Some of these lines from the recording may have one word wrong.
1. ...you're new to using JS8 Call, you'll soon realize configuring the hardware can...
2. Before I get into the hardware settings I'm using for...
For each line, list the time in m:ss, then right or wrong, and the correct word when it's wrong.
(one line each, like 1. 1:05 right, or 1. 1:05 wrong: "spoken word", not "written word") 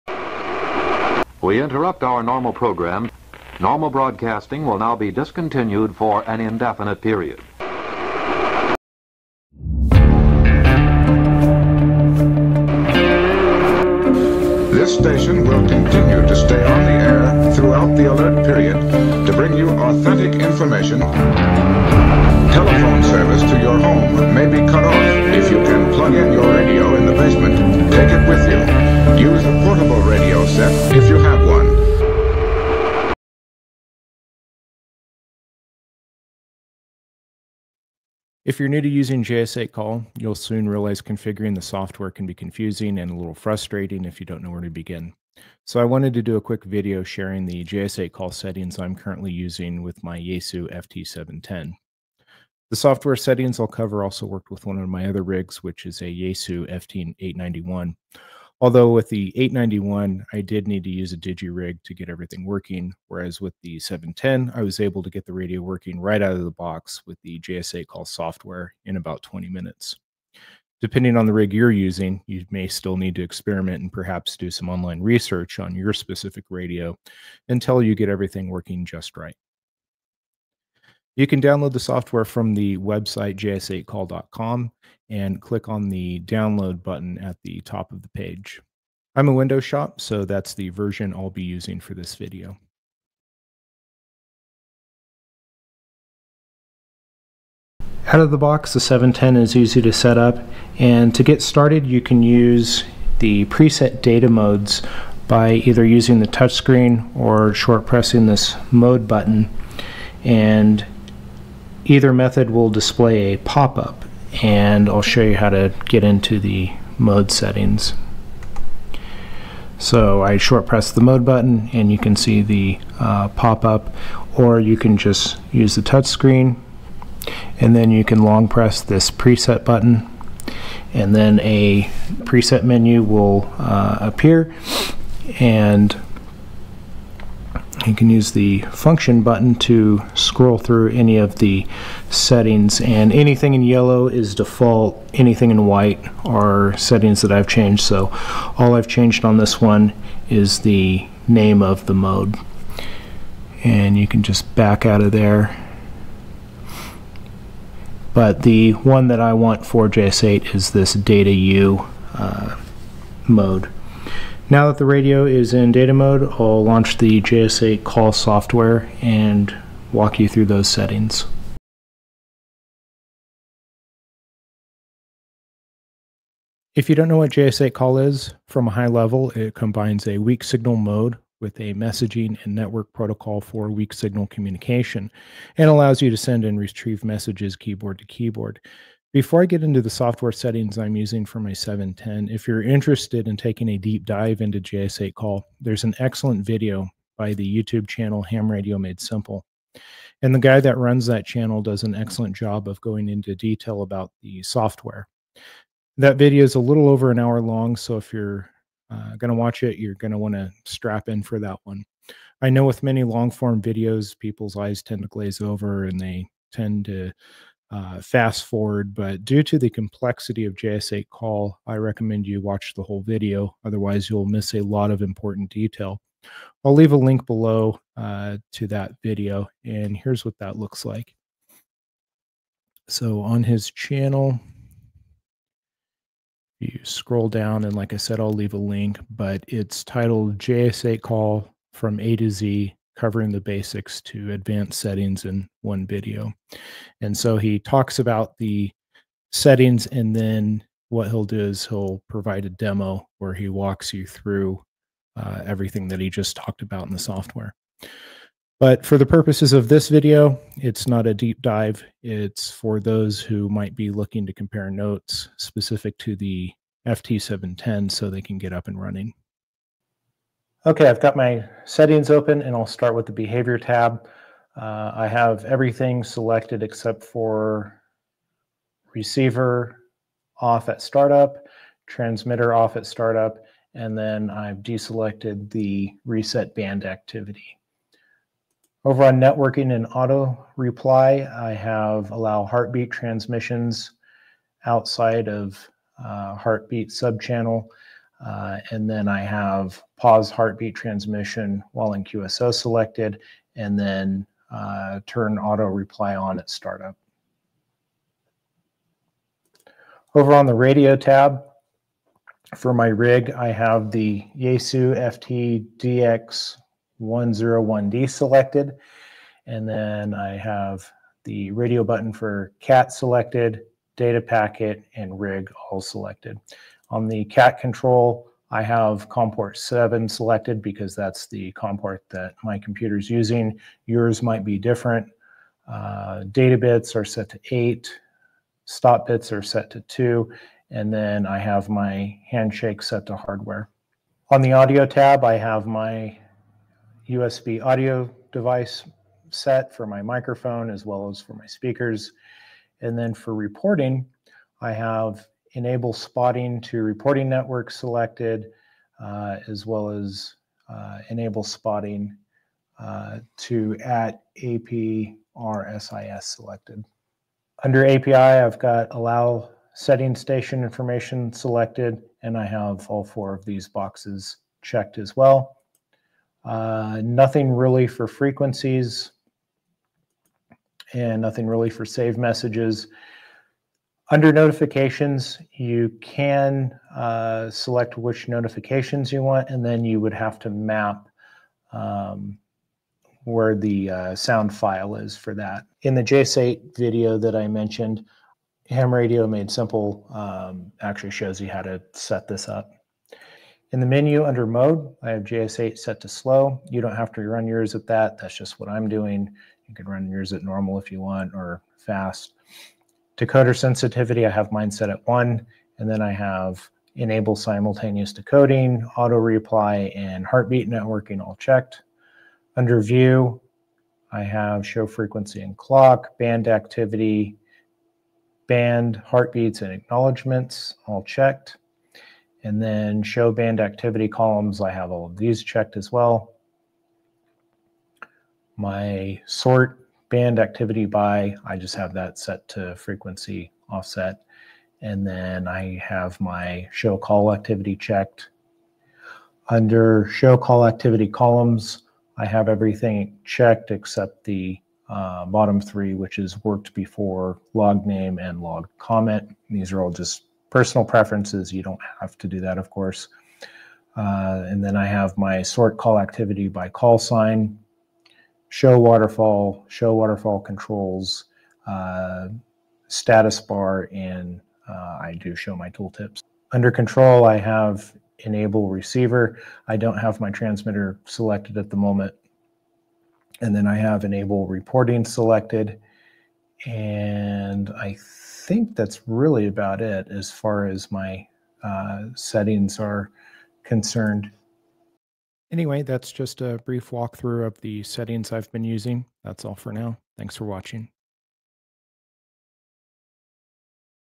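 1. 0:38 wrong: "software", not "hardware"
2. 3:09 wrong: "software", not "hardware".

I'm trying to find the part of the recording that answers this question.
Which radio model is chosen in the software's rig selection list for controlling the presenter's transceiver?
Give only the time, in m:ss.
5:14.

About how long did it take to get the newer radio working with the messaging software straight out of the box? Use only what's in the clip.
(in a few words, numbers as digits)
20 minutes.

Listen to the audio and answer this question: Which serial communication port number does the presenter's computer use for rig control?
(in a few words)
7.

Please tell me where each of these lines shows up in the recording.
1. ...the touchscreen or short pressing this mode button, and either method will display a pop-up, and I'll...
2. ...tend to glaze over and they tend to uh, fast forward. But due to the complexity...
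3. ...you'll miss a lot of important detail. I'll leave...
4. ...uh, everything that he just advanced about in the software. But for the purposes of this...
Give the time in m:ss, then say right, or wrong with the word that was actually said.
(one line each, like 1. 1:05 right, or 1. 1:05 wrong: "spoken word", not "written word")
1. 1:46 right
2. 3:34 right
3. 3:44 right
4. 4:15 wrong: "talked", not "advanced".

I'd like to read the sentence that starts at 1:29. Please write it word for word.
I'm a Windows shop, so that's the version I'll be using for this video.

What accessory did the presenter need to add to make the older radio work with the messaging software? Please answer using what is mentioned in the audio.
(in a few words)
digi-rig.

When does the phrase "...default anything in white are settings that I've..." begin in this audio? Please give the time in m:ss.
2:24.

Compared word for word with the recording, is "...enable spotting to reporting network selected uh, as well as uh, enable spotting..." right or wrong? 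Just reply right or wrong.
right.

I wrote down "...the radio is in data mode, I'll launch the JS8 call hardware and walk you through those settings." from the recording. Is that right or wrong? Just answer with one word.
wrong.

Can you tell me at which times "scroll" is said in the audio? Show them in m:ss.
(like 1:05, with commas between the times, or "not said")
2:20, 3:56.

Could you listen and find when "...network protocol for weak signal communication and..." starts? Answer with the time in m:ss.
3:02.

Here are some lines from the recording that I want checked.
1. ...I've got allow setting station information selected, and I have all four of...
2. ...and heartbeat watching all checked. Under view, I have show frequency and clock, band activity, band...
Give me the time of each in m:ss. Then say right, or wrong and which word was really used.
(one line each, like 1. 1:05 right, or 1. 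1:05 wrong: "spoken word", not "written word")
1. 6:08 right
2. 6:59 wrong: "networking", not "watching".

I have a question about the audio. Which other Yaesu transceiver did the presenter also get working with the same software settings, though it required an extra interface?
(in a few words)
Yaesu FT891.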